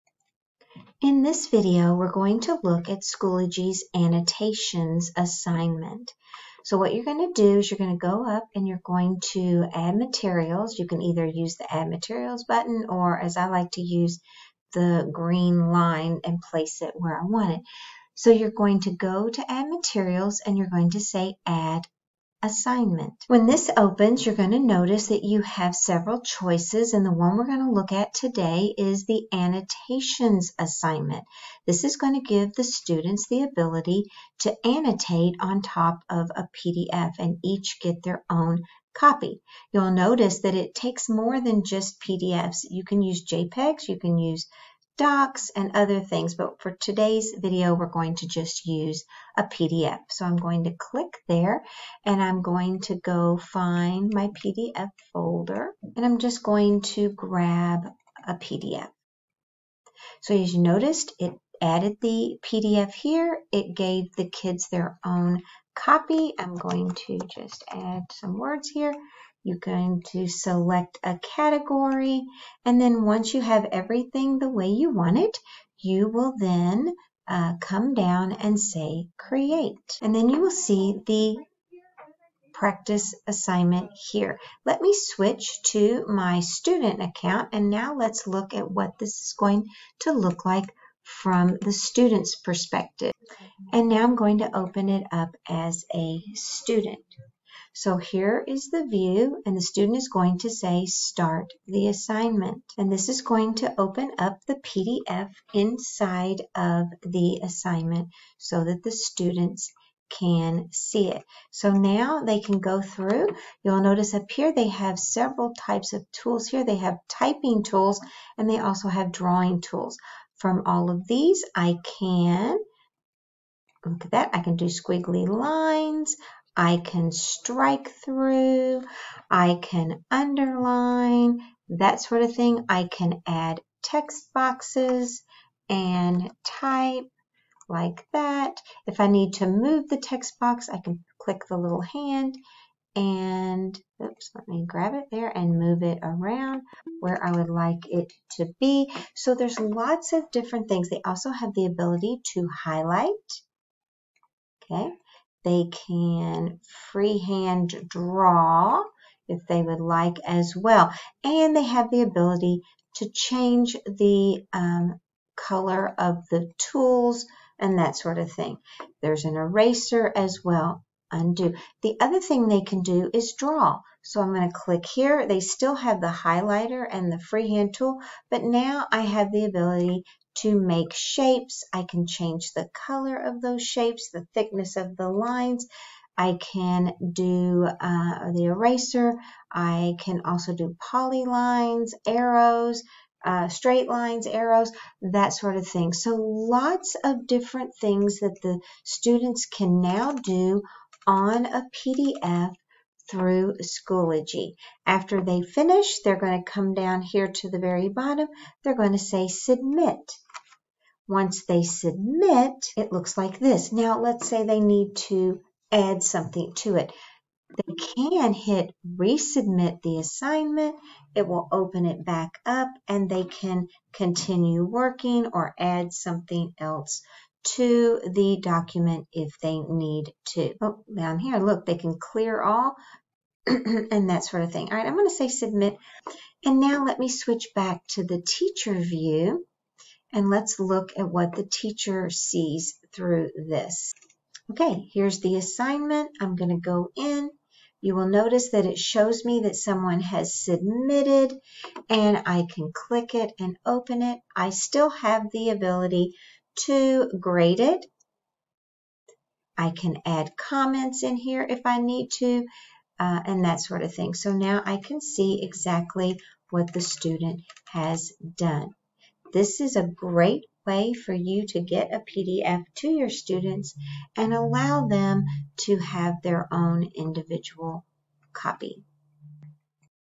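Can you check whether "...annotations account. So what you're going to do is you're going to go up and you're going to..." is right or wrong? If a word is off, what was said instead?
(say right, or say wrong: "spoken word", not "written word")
wrong: "assignment", not "account".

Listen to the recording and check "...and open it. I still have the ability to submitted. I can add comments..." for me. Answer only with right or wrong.
wrong.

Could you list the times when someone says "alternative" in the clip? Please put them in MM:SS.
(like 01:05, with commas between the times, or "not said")
not said.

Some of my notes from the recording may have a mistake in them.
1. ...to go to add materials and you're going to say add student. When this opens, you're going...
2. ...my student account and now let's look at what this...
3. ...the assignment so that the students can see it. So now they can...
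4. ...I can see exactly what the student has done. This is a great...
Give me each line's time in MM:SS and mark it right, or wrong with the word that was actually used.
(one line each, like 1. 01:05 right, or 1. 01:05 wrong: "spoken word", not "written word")
1. 00:18 wrong: "assignment", not "student"
2. 01:26 right
3. 01:47 right
4. 04:24 right.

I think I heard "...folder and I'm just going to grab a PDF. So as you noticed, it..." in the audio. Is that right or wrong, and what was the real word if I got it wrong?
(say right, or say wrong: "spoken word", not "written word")
right.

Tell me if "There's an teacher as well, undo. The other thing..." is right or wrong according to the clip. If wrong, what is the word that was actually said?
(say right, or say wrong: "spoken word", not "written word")
wrong: "eraser", not "teacher".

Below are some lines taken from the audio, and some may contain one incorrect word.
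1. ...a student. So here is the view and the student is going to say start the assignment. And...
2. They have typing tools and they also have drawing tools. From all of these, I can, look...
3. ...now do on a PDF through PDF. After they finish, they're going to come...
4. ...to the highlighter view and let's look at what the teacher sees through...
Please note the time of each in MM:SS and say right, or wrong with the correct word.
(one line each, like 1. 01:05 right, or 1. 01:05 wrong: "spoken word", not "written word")
1. 01:35 right
2. 01:56 right
3. 03:19 wrong: "Schoology", not "PDF"
4. 03:57 wrong: "teacher", not "highlighter".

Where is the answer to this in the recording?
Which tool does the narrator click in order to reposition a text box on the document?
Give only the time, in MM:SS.
02:21.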